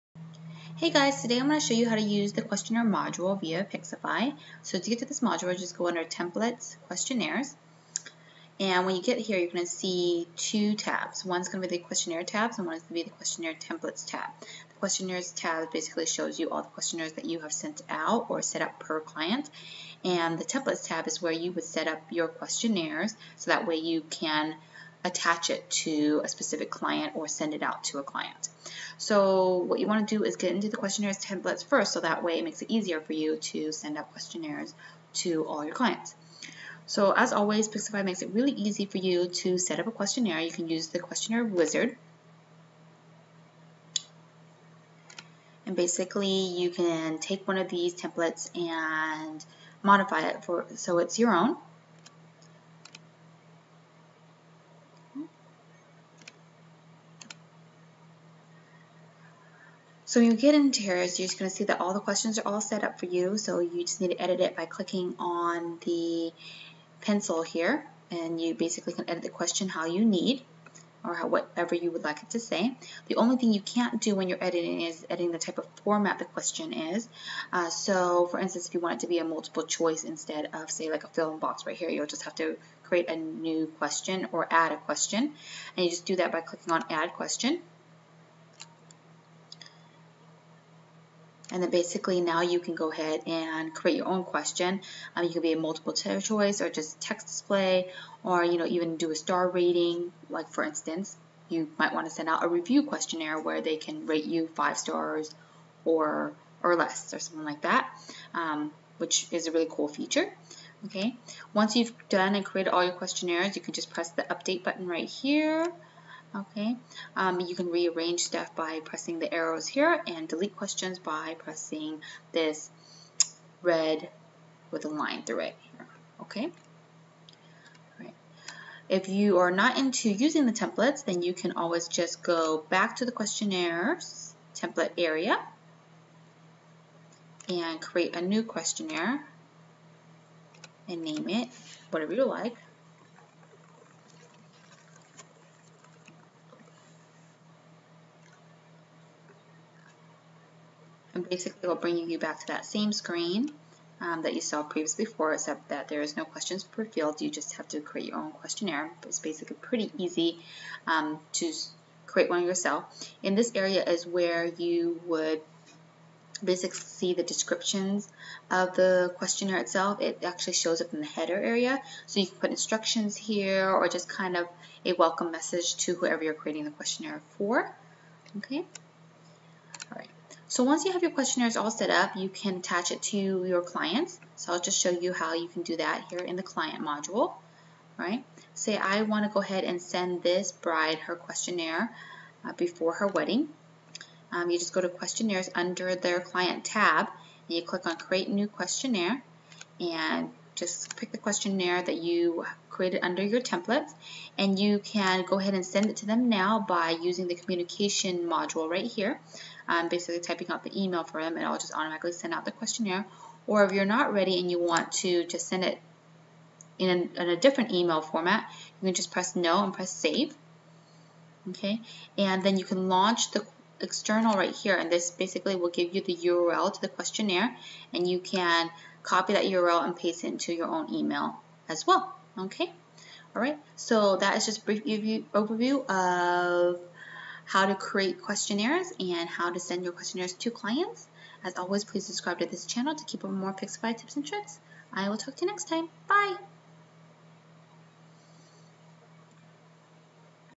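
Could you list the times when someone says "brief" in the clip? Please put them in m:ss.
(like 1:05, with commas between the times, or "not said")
3:54.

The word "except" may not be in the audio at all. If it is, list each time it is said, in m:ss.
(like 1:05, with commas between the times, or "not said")
2:35.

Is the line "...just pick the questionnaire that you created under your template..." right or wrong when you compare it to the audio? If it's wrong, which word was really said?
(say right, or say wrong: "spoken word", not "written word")
right.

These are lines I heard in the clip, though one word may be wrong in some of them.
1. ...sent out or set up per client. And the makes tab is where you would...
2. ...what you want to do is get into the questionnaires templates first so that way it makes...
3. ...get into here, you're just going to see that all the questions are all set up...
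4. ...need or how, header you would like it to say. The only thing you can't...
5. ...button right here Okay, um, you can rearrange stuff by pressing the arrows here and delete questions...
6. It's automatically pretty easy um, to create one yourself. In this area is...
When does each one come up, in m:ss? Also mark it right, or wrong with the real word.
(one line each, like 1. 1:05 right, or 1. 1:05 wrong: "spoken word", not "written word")
1. 0:17 wrong: "templates", not "makes"
2. 0:29 right
3. 1:00 right
4. 1:10 wrong: "whatever", not "header"
5. 1:54 right
6. 2:39 wrong: "basically", not "automatically".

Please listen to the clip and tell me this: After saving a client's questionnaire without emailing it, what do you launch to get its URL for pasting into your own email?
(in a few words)
the external.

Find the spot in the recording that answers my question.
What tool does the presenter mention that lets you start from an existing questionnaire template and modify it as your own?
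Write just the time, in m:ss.
0:40.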